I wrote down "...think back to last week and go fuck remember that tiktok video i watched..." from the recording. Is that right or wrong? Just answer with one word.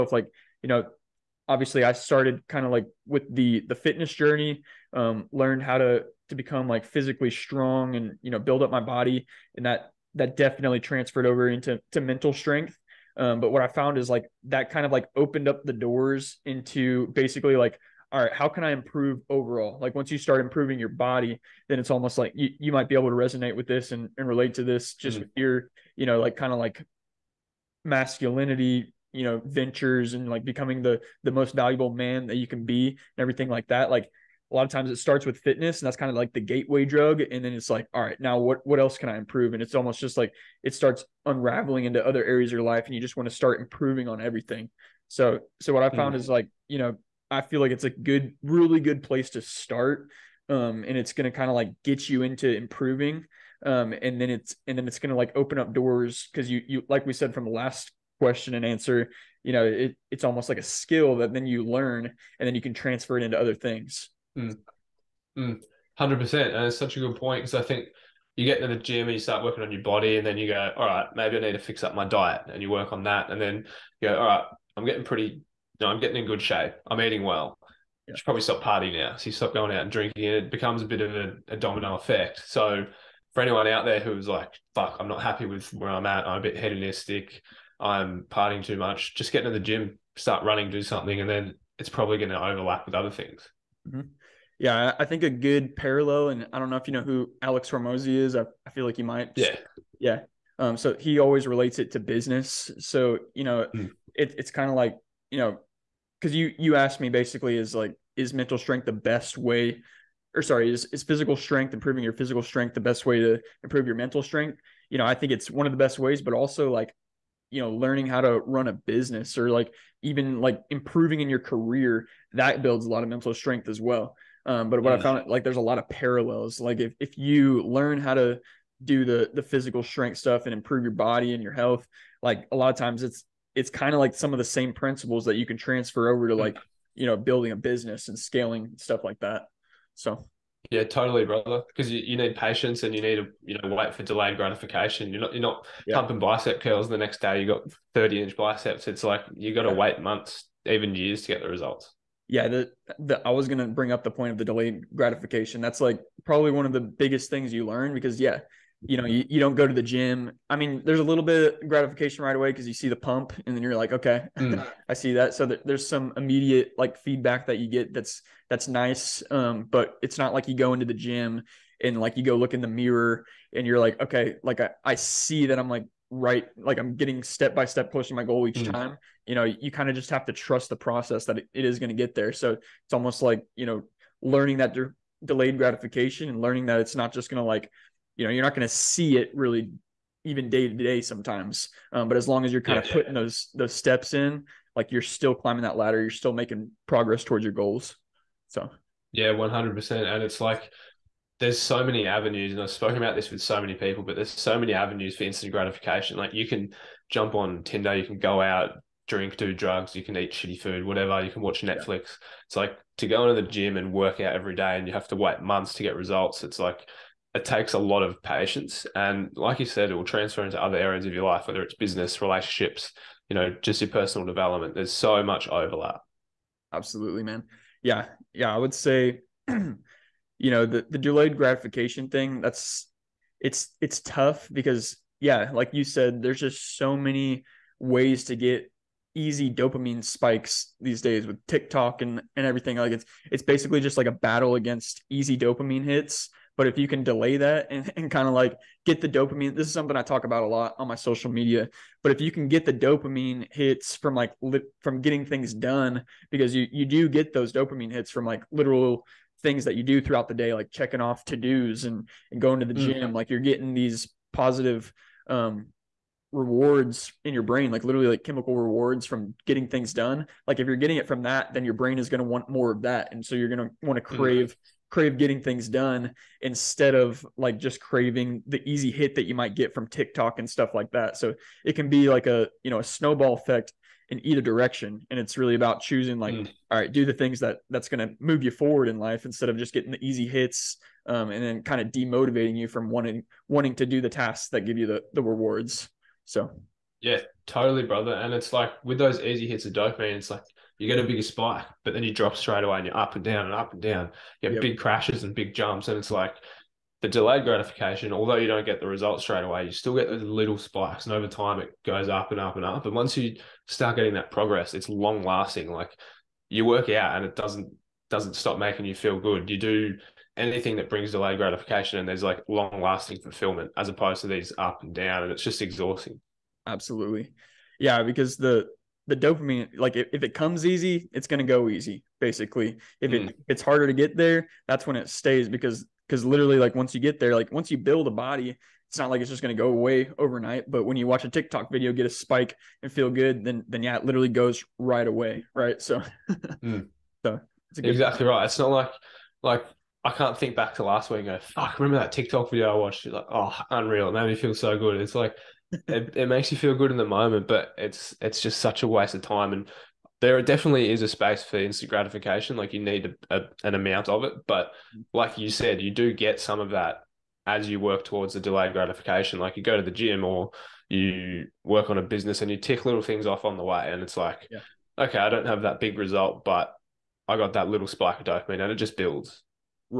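right.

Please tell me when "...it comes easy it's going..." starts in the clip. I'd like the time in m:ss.
5:30.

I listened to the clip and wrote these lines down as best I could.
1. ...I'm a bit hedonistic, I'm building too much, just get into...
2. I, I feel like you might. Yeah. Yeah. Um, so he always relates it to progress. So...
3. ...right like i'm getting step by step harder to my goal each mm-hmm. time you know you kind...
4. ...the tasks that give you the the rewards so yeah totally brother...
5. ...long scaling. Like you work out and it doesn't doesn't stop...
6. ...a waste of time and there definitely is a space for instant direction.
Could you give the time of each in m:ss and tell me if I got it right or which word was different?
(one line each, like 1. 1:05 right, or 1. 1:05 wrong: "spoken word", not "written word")
1. 1:26 wrong: "partying", not "building"
2. 1:38 wrong: "business", not "progress"
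3. 2:56 wrong: "closer", not "harder"
4. 4:53 right
5. 5:14 wrong: "lasting", not "scaling"
6. 5:58 wrong: "gratification", not "direction".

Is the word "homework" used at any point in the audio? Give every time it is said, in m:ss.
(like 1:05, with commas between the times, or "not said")
not said.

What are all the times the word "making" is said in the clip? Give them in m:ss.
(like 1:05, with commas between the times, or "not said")
3:16, 5:18.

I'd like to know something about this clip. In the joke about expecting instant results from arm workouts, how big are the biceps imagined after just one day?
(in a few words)
30 inch.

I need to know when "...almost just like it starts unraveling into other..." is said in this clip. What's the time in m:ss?
0:39.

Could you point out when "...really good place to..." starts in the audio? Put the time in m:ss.
0:48.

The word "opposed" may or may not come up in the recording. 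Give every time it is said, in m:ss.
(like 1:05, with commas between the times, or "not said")
5:23.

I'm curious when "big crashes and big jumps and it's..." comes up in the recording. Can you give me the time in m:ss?
5:04.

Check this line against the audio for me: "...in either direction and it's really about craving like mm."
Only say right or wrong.
wrong.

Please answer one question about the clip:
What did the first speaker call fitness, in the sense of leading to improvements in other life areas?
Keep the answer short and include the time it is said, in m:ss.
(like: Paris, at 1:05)
the gateway drug, at 0:36.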